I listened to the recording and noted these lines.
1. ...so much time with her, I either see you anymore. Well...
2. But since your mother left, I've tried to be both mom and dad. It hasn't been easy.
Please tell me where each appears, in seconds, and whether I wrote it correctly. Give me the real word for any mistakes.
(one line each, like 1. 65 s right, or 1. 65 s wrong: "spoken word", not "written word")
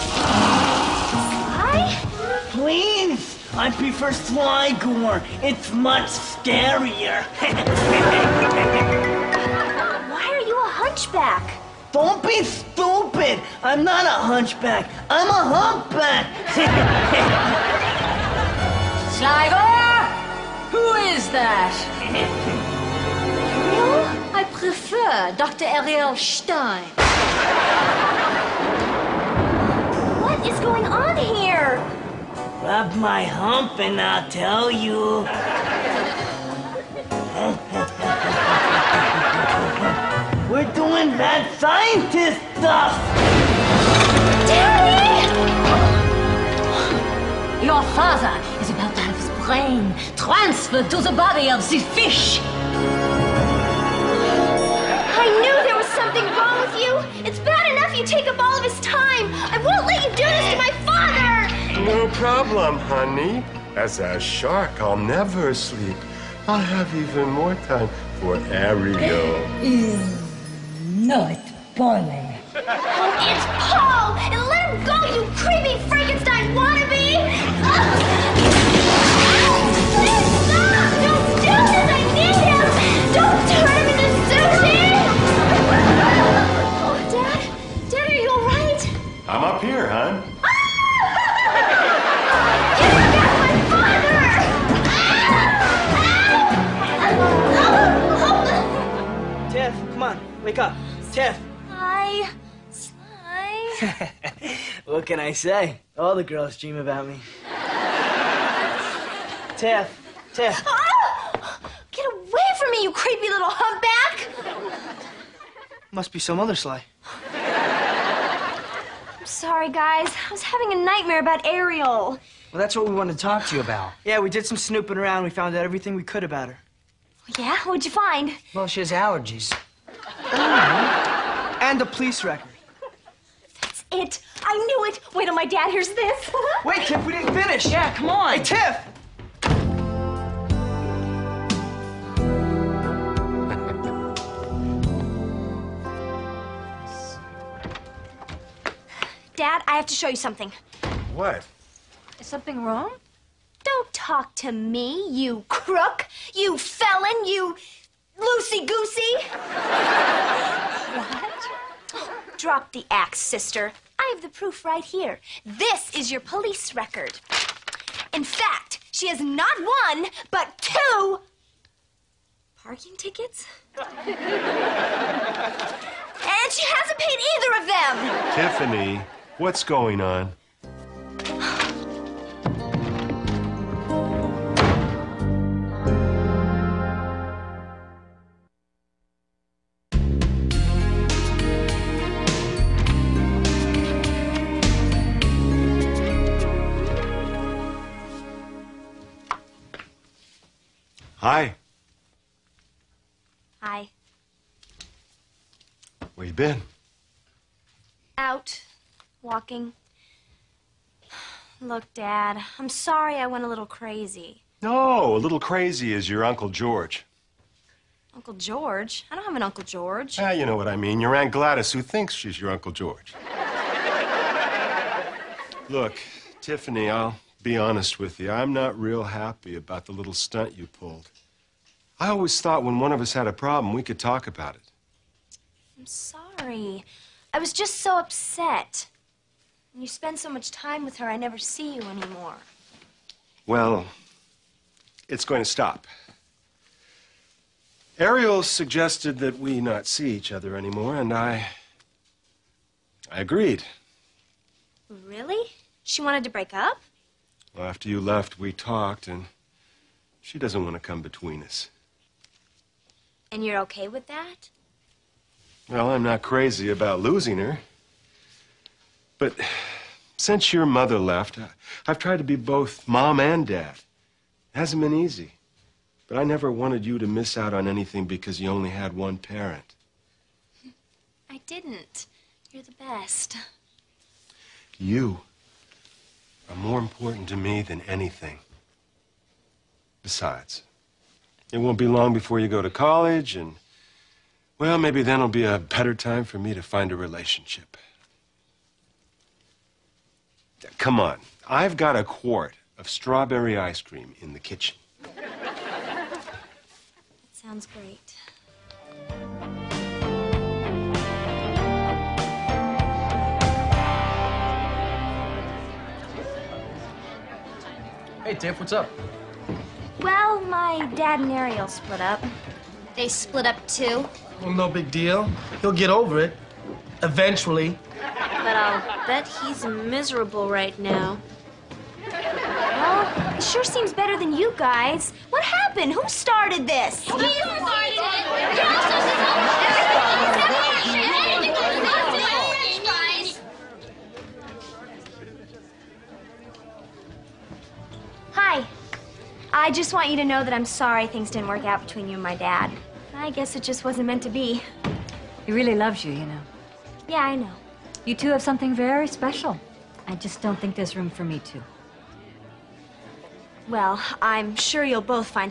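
1. 240 s wrong: "never", not "either"
2. 269 s right.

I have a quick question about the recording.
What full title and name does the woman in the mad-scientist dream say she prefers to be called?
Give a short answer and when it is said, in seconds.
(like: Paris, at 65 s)
Dr. Ariel Stein, at 25 s.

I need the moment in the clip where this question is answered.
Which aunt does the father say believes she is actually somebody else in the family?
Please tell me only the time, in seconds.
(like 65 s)
221 s.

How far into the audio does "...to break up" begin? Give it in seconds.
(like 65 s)
256 s.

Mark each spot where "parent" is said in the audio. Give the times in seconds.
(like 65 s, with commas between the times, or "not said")
279 s.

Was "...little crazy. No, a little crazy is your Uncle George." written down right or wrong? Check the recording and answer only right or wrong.
right.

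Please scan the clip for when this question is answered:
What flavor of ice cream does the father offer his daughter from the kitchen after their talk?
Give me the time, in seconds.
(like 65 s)
302 s.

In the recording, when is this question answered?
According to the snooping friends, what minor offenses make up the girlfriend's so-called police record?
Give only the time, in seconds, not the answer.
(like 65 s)
170 s.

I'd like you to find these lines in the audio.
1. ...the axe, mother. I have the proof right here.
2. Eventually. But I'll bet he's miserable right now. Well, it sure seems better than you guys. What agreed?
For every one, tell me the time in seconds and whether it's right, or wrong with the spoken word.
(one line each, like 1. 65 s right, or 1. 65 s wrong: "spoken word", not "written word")
1. 162 s wrong: "sister", not "mother"
2. 327 s wrong: "happened", not "agreed".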